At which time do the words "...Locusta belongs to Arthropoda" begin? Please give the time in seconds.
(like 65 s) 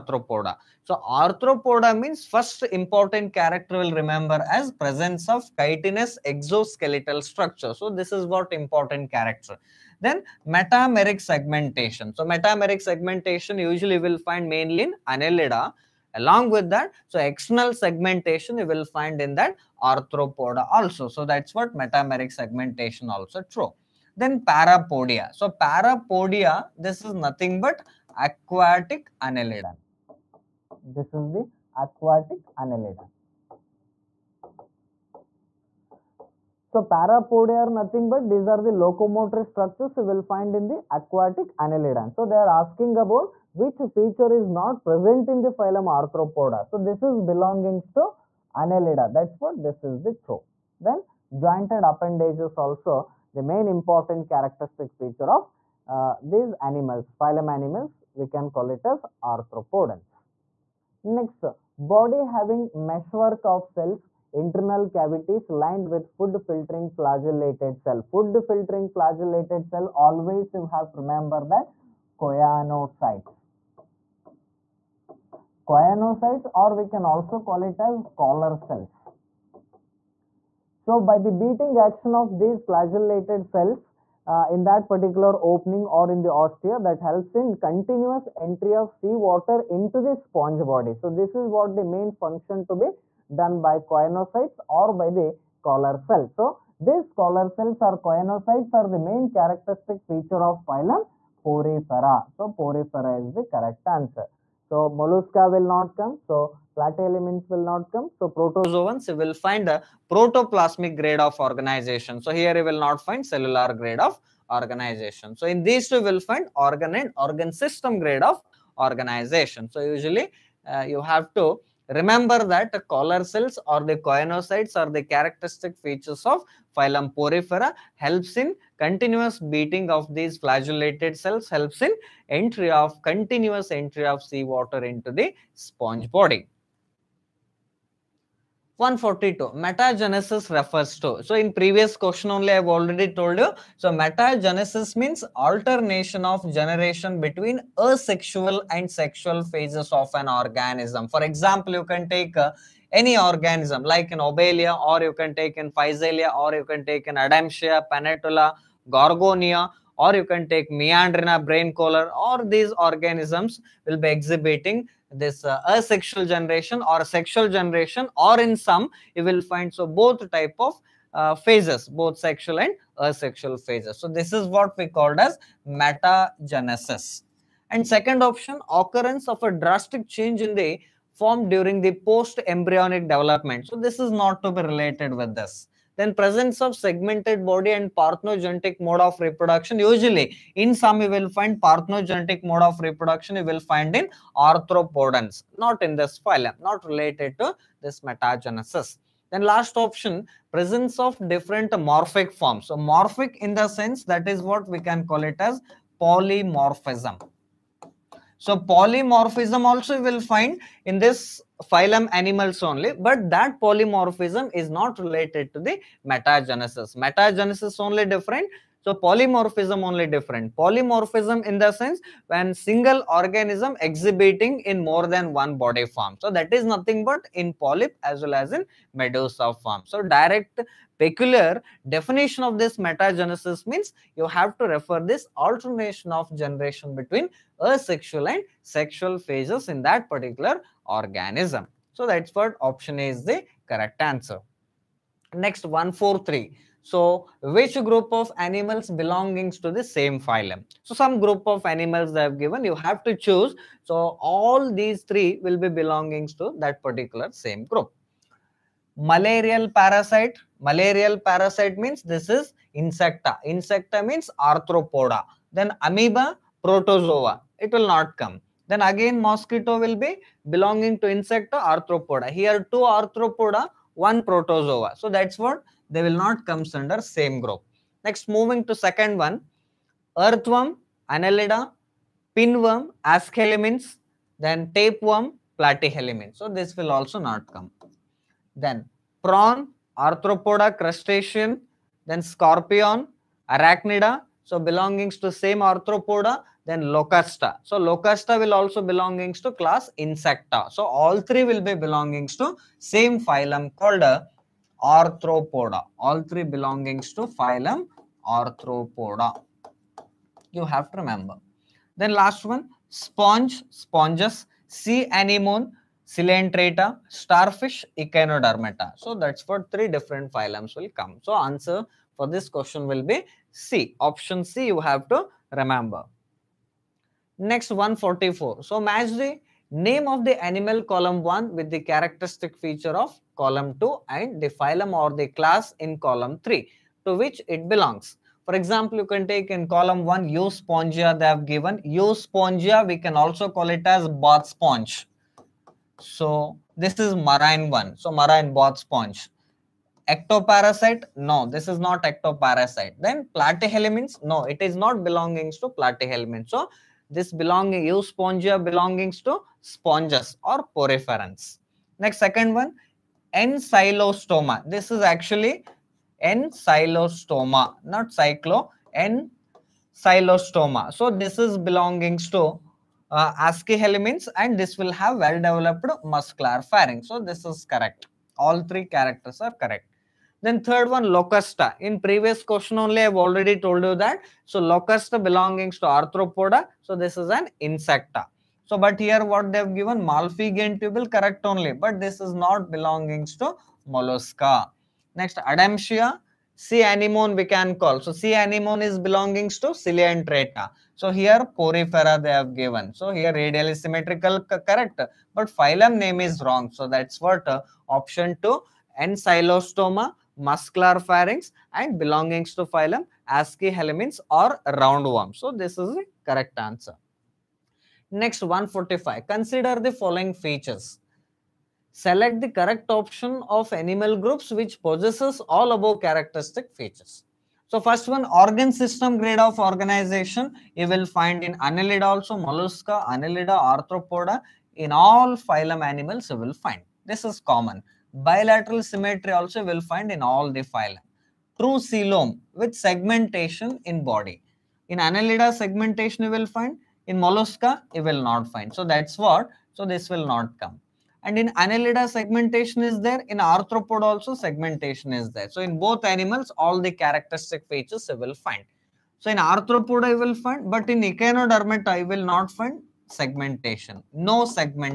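384 s.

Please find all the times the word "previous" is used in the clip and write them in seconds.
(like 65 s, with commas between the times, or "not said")
141 s, 381 s.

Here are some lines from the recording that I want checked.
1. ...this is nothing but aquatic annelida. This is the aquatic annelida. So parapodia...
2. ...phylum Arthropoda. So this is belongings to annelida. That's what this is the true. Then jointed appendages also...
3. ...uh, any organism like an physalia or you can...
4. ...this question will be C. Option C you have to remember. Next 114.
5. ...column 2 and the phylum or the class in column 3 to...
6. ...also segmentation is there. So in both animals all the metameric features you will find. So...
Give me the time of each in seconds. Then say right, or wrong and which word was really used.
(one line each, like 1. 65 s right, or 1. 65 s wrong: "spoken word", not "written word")
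1. 26 s right
2. 45 s right
3. 152 s wrong: "obelia", not "physalia"
4. 322 s wrong: "144", not "114"
5. 333 s right
6. 454 s wrong: "characteristic", not "metameric".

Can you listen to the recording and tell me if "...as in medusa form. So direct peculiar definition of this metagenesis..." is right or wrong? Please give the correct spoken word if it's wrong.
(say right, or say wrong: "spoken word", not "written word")
right.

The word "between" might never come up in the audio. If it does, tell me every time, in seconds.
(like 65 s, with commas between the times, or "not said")
147 s, 236 s.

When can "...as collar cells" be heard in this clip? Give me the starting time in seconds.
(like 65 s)
77 s.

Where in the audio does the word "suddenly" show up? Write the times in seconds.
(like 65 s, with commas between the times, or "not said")
not said.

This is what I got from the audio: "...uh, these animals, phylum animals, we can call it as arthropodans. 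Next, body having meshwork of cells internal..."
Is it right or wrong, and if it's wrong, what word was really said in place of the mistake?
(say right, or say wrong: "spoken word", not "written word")
right.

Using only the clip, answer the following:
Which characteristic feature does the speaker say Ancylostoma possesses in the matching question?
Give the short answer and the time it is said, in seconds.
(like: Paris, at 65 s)
Well developed muscular pharynx, at 375 s.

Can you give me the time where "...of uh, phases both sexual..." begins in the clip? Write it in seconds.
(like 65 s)
170 s.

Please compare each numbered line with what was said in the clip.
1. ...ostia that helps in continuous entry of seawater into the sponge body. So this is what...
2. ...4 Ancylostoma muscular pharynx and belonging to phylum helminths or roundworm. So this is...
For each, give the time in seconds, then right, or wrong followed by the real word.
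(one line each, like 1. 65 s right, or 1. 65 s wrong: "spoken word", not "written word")
1. 86 s right
2. 408 s wrong: "2", not "4".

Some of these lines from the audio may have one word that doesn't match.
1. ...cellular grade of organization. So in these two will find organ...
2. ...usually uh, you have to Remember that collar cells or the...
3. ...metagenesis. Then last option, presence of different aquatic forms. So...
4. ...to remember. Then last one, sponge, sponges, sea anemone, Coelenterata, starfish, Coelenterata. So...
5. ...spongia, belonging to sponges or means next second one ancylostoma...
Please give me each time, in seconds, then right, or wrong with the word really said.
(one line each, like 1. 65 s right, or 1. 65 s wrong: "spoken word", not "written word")
1. 113 s right
2. 119 s right
3. 198 s wrong: "morphic", not "aquatic"
4. 310 s wrong: "Echinodermata", not "Coelenterata"
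5. 358 s wrong: "poriferans", not "means".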